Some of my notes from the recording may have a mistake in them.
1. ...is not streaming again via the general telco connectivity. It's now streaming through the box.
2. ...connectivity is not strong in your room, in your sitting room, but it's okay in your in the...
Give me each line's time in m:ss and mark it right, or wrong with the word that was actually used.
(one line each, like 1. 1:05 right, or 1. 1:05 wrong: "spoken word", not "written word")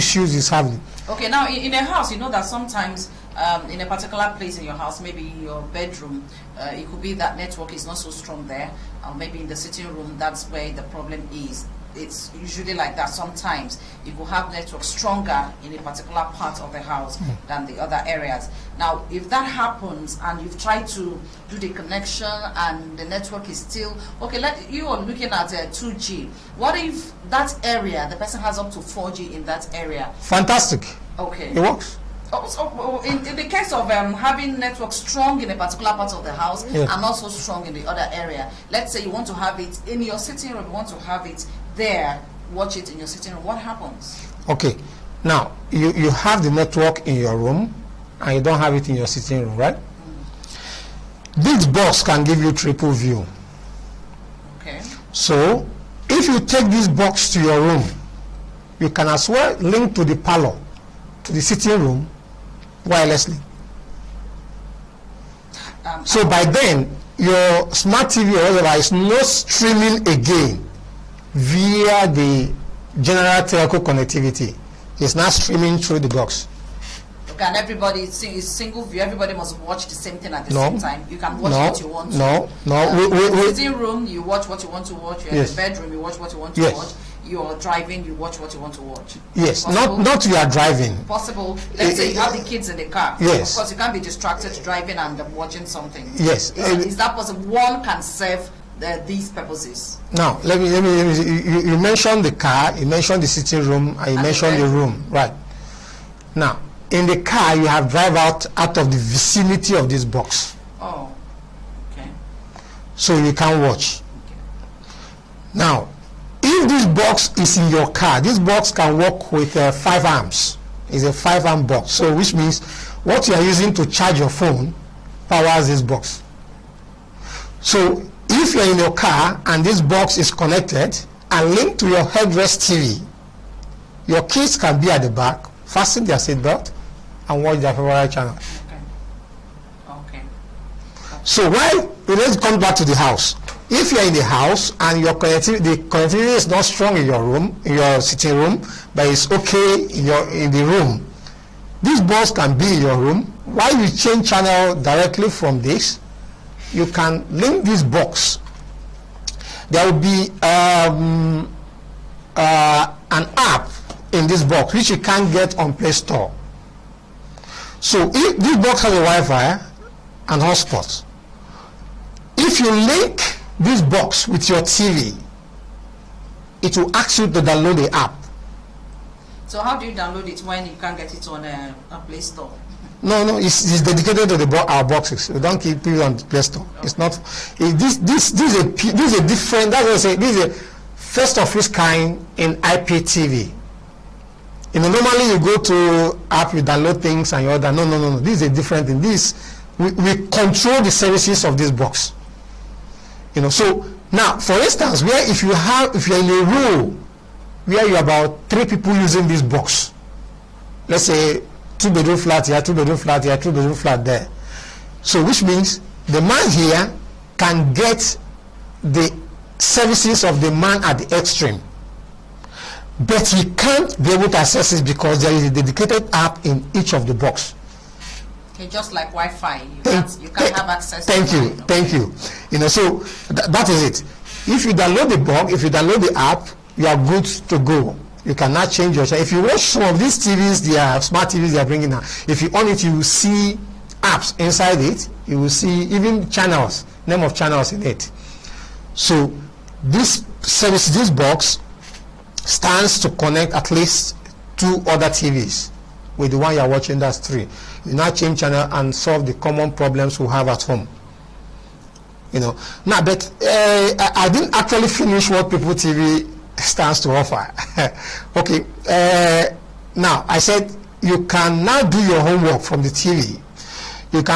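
1. 1:08 right
2. 2:25 right.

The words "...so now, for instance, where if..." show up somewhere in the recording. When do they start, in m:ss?
3:23.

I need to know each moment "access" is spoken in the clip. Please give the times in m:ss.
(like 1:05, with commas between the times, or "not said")
3:44, 3:50.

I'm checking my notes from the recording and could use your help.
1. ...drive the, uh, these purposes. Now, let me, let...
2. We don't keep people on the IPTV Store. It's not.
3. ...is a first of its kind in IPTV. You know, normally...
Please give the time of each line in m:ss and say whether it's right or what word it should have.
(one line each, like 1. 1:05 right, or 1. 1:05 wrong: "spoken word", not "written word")
1. 1:38 wrong: "serve", not "drive"
2. 3:05 wrong: "Play", not "IPTV"
3. 3:10 right.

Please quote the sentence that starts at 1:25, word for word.
in the bedroom, you watch what you want to yes.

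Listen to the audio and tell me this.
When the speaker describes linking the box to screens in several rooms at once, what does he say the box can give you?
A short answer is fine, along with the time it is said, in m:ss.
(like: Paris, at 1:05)
triple view, at 0:52.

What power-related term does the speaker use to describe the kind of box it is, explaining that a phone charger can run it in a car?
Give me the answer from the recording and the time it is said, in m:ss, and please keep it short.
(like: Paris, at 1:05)
five-arm box, at 2:01.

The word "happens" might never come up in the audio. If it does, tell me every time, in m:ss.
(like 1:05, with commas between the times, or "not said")
0:19, 0:43.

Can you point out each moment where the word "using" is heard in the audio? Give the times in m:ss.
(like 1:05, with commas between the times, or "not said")
2:03, 3:28.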